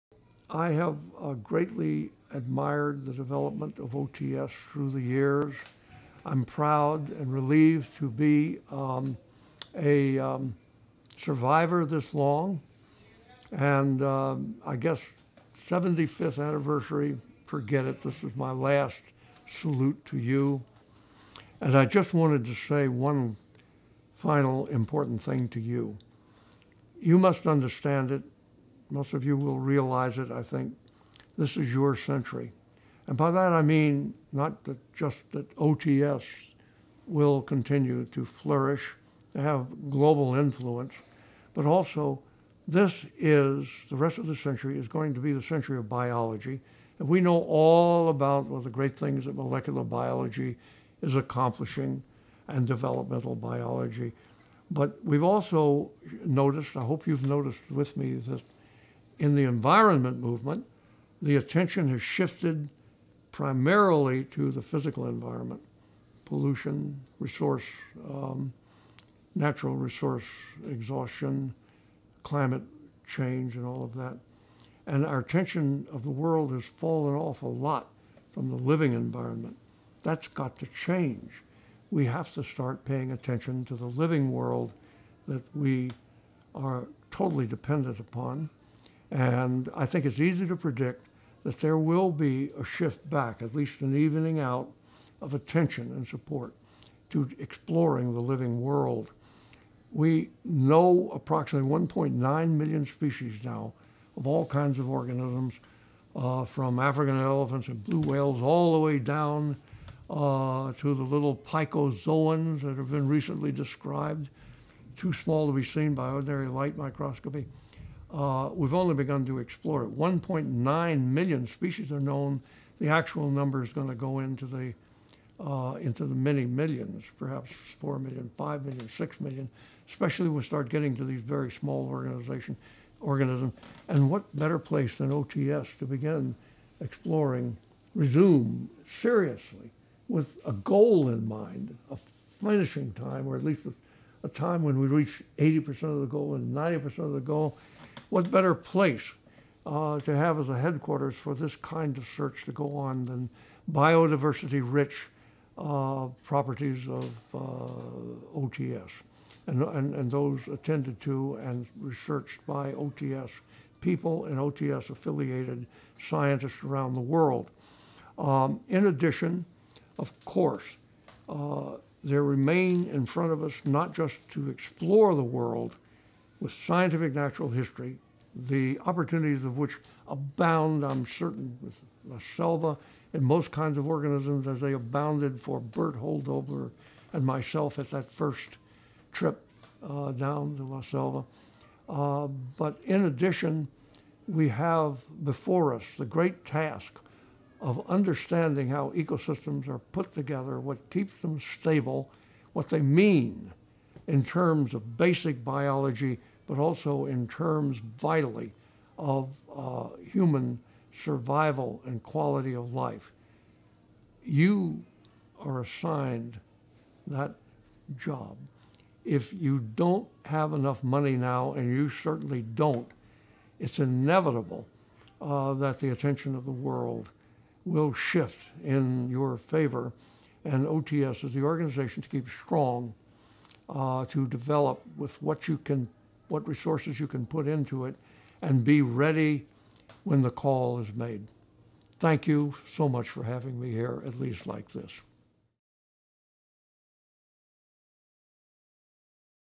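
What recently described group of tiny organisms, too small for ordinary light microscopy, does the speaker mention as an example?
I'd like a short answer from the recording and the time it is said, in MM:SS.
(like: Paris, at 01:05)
picozoans, at 01:51.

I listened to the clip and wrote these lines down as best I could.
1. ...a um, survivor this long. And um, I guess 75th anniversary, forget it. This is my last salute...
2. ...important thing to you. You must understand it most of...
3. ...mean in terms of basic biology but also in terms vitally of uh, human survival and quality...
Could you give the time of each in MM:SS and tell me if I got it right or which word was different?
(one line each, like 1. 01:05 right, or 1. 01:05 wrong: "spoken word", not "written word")
1. 00:09 right
2. 00:24 right
3. 03:22 right.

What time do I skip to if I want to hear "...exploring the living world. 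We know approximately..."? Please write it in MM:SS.
01:37.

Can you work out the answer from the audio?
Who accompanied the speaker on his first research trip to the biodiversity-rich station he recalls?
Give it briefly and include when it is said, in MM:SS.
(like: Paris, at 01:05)
Bert Hölldobler, at 03:05.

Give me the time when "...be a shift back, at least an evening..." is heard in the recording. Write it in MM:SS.
01:32.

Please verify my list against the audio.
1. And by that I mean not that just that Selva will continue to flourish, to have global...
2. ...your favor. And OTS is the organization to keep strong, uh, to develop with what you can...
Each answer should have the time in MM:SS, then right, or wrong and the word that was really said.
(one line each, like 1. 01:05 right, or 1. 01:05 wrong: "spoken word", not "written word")
1. 00:33 wrong: "OTS", not "Selva"
2. 03:49 right.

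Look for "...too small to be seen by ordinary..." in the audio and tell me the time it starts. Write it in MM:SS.
01:54.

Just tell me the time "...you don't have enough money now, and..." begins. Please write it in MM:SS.
03:39.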